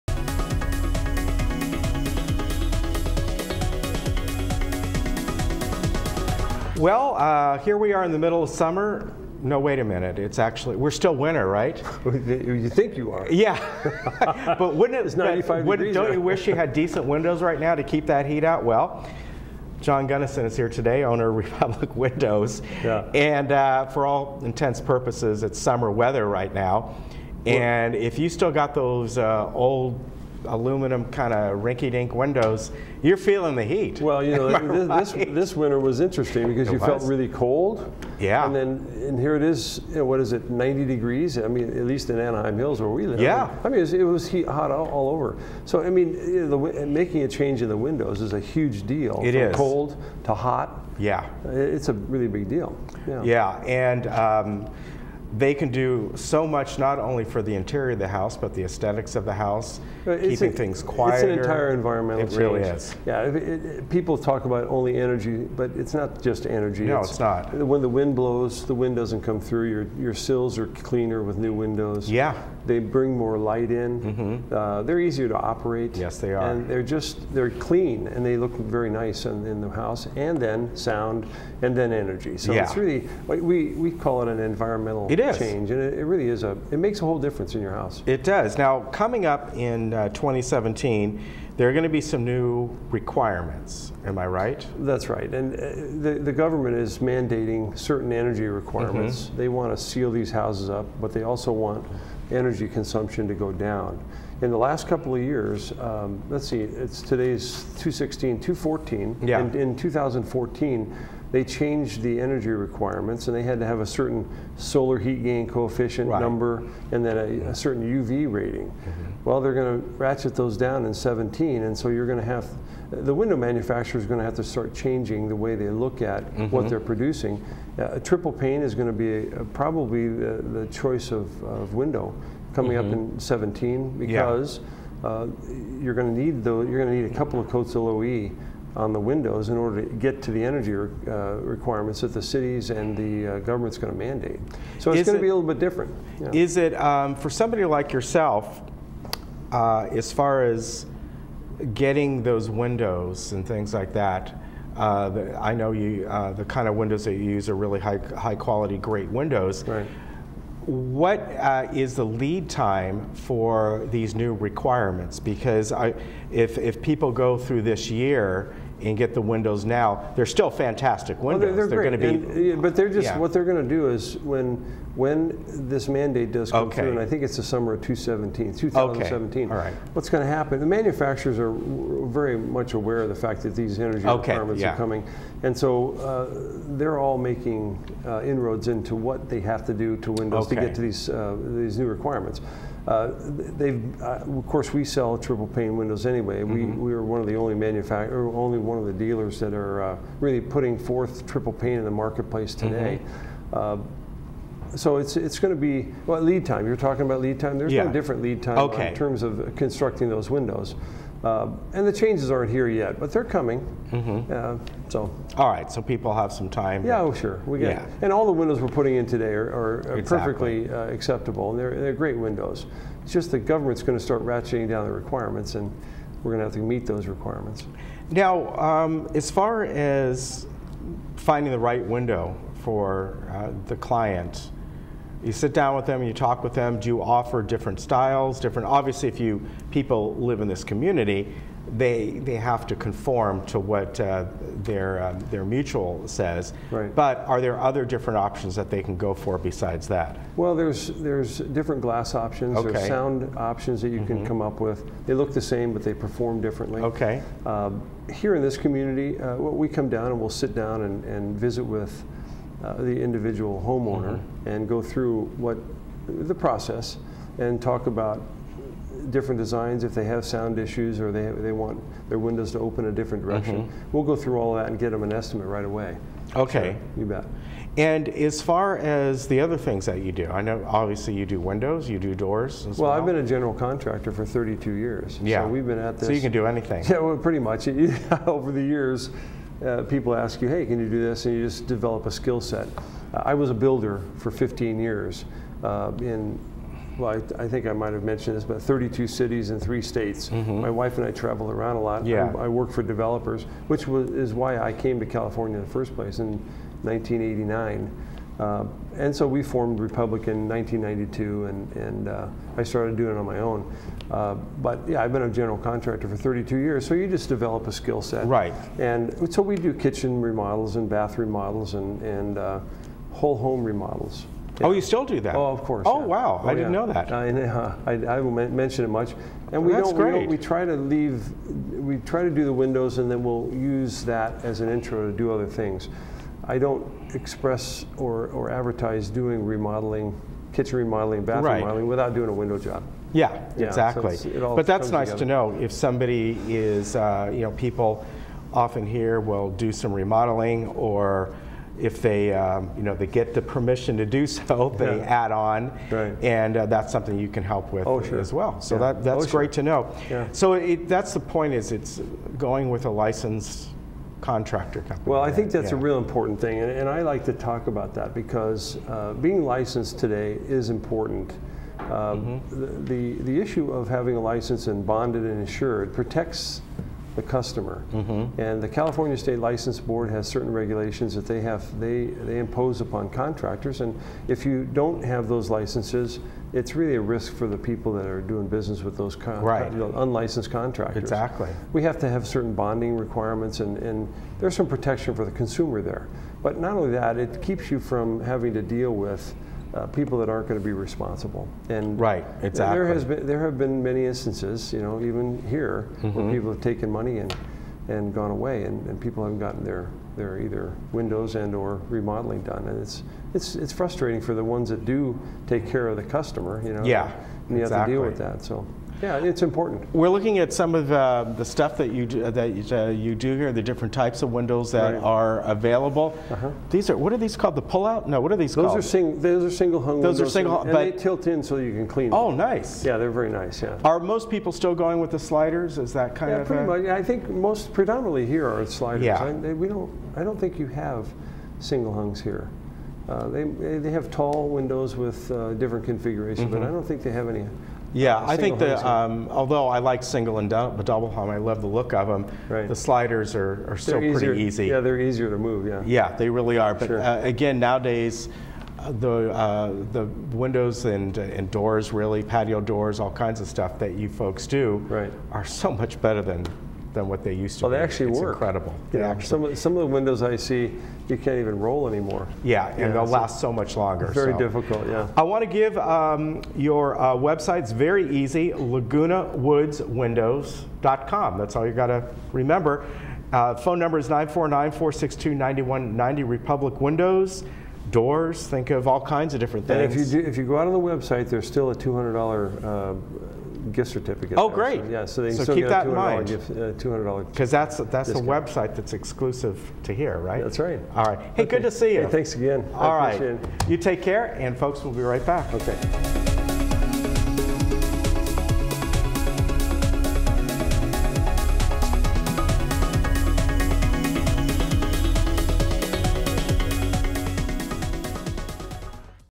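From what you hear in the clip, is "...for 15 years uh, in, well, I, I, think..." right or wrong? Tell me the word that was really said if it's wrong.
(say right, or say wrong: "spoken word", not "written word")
right.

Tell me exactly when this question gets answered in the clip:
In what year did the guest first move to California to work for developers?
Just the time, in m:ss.
5:06.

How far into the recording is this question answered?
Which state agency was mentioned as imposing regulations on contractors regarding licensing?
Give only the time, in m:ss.
6:18.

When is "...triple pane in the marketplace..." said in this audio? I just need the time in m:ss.
3:21.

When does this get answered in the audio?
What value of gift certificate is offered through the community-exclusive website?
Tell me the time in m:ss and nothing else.
8:11.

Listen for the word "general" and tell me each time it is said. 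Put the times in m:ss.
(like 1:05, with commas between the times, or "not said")
4:43, 5:15.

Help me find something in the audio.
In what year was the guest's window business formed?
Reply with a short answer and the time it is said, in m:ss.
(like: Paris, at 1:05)
1992, at 5:10.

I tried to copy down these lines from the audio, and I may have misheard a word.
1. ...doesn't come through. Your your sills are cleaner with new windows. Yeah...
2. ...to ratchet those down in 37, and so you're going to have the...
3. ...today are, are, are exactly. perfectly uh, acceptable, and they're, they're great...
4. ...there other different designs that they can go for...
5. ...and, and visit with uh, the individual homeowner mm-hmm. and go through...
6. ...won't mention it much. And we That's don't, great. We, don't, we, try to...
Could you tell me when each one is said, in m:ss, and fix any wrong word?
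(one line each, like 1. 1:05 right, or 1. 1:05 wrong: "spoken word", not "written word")
1. 1:08 right
2. 1:59 wrong: "17", not "37"
3. 3:39 right
4. 4:07 wrong: "options", not "designs"
5. 4:20 right
6. 5:28 right.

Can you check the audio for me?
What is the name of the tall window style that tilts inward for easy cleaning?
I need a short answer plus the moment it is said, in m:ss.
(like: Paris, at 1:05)
Single hung, at 7:09.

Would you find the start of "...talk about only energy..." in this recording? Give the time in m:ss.
1:04.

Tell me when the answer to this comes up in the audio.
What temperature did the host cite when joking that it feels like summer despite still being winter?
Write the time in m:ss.
0:15.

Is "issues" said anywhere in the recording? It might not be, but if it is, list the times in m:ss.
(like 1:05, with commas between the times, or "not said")
4:30, 6:13.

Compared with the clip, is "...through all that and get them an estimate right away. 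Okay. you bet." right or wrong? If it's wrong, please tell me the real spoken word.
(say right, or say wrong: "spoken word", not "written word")
right.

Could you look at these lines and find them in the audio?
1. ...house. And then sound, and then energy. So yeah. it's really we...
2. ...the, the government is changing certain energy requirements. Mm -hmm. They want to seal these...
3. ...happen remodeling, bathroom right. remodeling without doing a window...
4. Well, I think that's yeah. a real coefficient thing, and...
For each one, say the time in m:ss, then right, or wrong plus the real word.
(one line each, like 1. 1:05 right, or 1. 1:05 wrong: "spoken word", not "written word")
1. 1:19 right
2. 1:36 wrong: "mandating", not "changing"
3. 5:40 wrong: "kitchen", not "happen"
4. 6:05 wrong: "important", not "coefficient".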